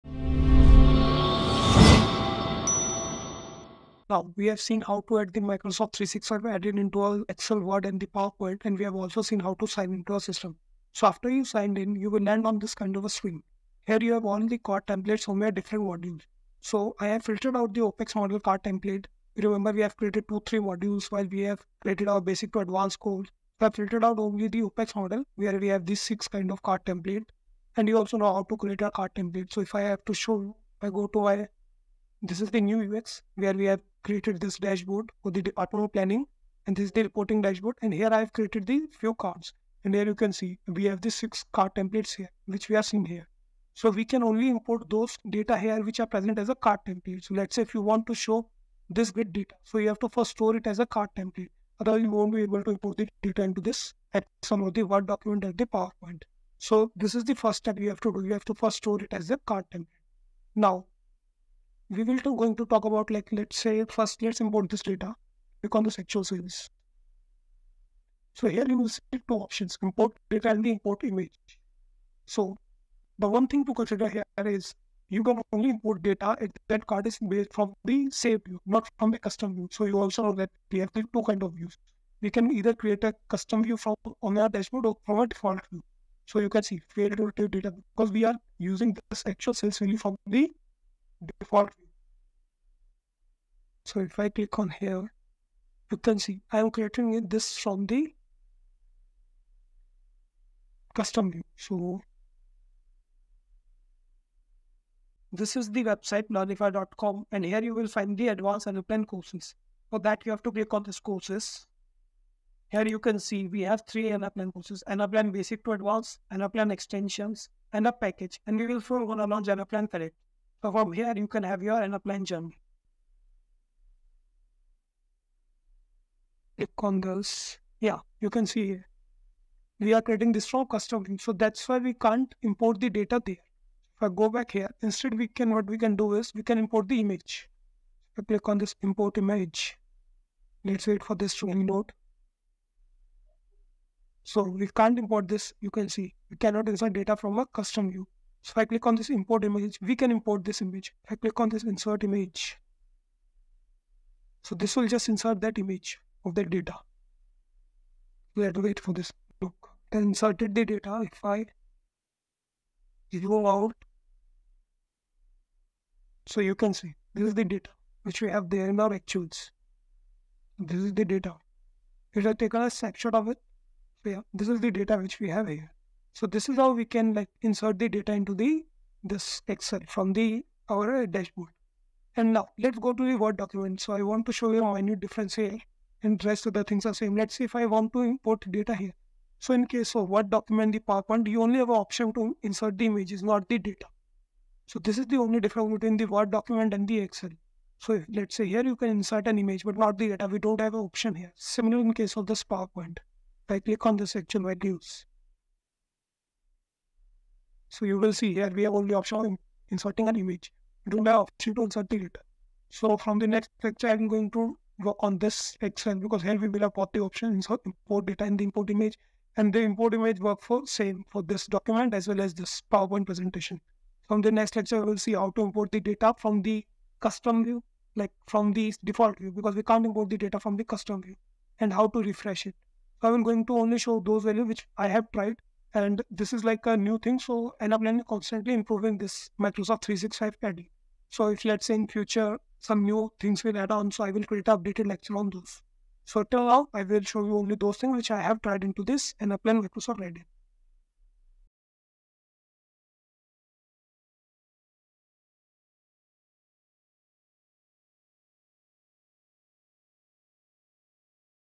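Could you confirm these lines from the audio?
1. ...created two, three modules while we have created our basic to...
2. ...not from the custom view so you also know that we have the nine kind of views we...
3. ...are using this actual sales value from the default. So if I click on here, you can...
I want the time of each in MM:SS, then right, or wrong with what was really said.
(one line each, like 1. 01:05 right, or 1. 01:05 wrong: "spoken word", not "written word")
1. 00:19 right
2. 01:18 wrong: "two", not "nine"
3. 01:28 right.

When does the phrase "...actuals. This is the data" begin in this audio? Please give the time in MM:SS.
02:48.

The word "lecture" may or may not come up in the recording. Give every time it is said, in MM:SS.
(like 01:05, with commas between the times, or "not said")
03:33, 03:44, 04:04.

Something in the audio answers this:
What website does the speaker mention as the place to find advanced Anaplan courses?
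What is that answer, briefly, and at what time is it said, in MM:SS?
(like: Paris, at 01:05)
learnefy.com, at 01:46.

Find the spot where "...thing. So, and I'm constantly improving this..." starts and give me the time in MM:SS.
03:56.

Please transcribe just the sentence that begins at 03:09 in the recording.
So in case of Word document, the PowerPoint, you only have an option to insert the images, not the data.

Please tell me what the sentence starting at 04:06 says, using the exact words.
So till now, I will show you only those things which I have tried into this Anaplan Microsoft Reddit.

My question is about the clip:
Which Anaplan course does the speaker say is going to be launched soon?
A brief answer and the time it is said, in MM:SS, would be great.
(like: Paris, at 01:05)
Anaplan Connect, at 01:59.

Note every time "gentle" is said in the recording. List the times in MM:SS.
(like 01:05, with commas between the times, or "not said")
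not said.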